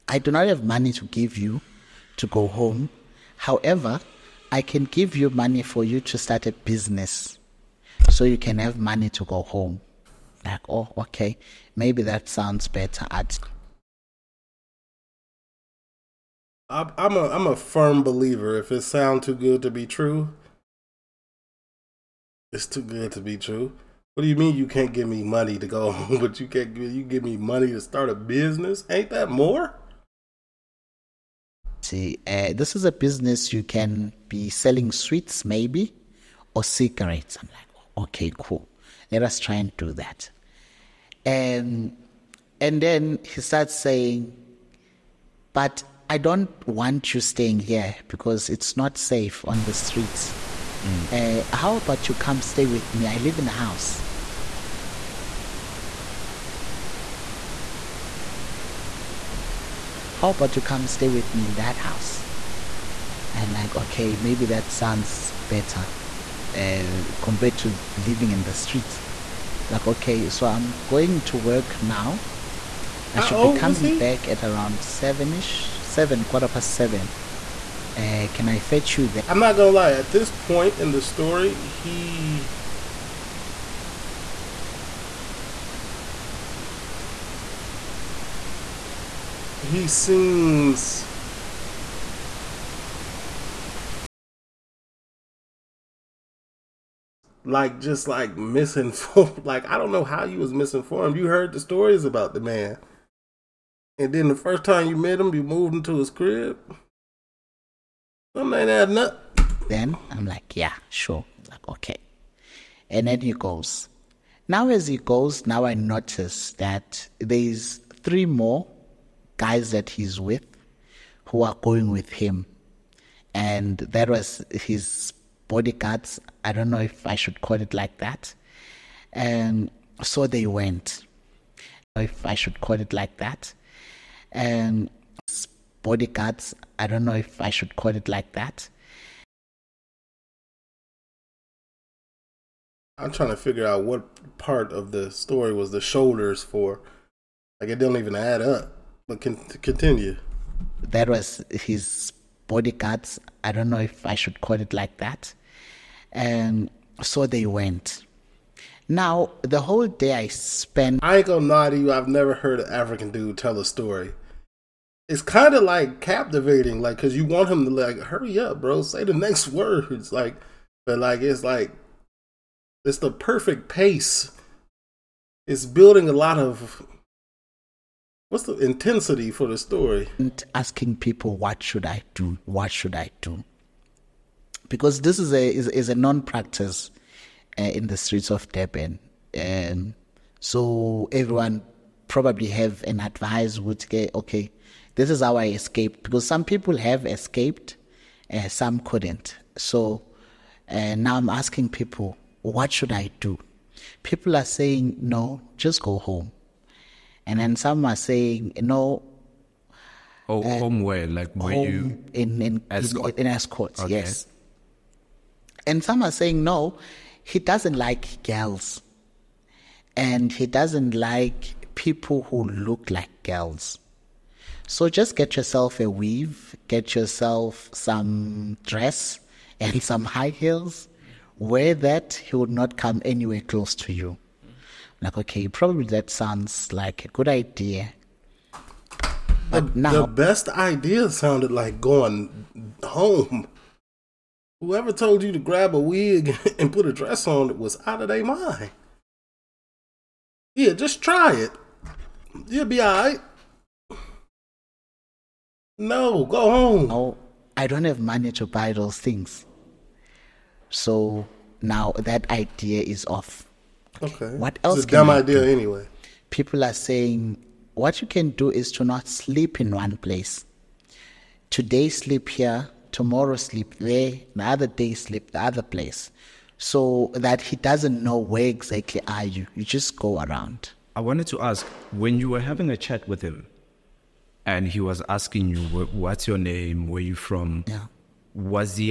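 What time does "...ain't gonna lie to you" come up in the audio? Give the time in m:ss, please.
2:41.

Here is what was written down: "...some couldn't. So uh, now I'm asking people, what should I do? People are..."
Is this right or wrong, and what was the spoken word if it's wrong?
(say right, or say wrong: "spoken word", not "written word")
right.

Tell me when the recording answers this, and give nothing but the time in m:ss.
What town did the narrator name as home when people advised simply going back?
3:32.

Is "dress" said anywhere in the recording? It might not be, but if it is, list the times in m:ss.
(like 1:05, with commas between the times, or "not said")
3:48, 4:06.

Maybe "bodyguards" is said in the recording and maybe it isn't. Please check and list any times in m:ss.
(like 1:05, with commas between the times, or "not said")
2:05, 2:15, 2:32.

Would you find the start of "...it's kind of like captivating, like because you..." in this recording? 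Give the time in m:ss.
2:45.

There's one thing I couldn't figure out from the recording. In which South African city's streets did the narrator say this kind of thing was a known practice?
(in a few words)
Durban.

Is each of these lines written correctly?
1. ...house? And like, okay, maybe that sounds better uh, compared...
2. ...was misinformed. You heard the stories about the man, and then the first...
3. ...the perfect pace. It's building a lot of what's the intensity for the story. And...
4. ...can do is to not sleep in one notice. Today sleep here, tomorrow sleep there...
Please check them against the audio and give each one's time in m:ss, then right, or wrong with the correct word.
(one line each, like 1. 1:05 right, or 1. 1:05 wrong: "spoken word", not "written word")
1. 1:01 right
2. 1:40 right
3. 2:52 right
4. 4:28 wrong: "place", not "notice".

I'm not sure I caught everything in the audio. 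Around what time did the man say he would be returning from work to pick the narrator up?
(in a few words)
Quarter past 7.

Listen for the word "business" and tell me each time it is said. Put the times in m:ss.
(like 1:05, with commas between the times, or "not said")
0:06, 0:28, 0:32.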